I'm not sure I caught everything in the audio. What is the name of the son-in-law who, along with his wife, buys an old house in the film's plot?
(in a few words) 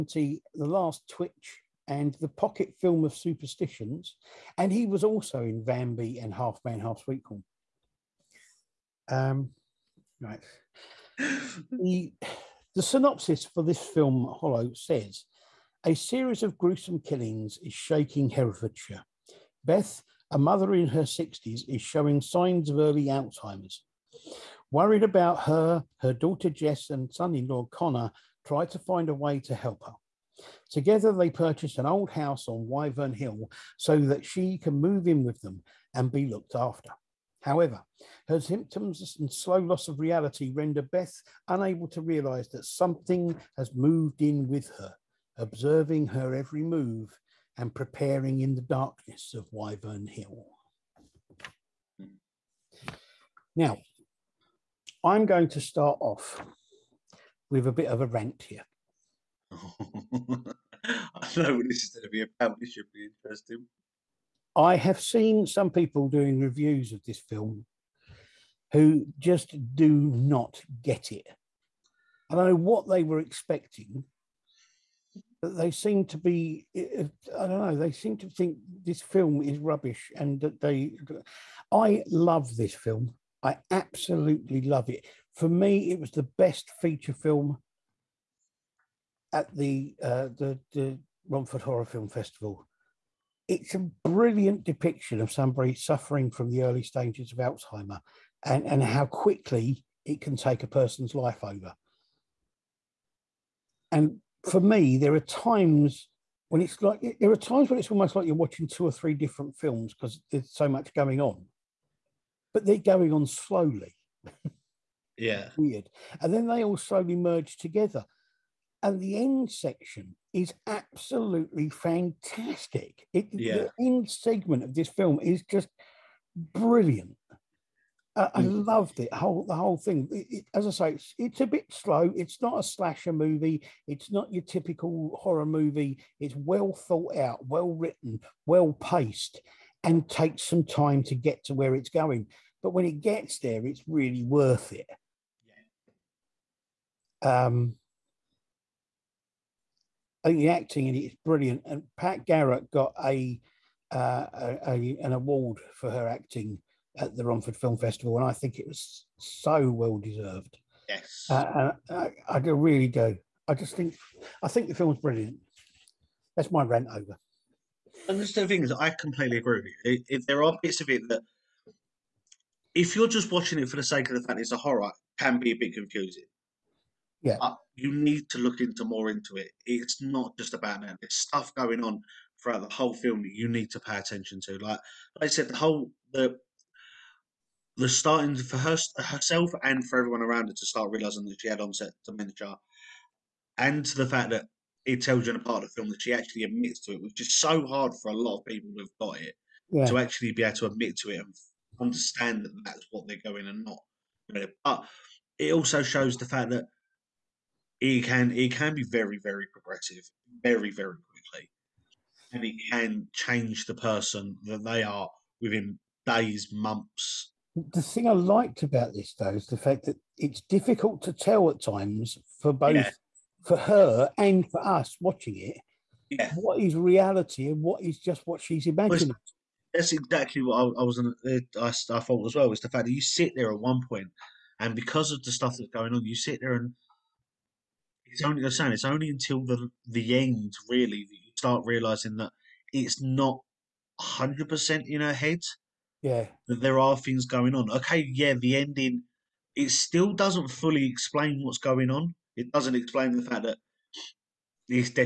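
Connor.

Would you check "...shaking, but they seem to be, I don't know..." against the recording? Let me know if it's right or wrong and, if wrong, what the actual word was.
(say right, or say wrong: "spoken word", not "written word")
wrong: "expecting", not "shaking".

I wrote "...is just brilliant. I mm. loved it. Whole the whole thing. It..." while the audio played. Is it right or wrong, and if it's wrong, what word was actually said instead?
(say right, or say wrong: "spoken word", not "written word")
right.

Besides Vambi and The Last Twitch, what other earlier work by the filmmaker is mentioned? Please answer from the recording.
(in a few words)
Half Man, Half Sweetcorn.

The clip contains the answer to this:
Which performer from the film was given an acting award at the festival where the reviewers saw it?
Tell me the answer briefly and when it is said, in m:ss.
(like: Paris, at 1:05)
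Pat Garrett, at 2:31.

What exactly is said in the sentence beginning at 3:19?
to actually be able to admit to it and understand that that's what they're going and not.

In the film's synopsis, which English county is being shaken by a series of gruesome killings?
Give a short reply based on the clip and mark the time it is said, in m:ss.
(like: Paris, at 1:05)
Herefordshire, at 0:18.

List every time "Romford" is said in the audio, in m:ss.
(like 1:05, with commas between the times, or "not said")
1:31, 2:37.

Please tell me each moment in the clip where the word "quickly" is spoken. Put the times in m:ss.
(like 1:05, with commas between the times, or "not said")
1:39, 3:31.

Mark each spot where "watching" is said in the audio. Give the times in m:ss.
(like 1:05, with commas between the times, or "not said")
1:48, 2:53, 3:45.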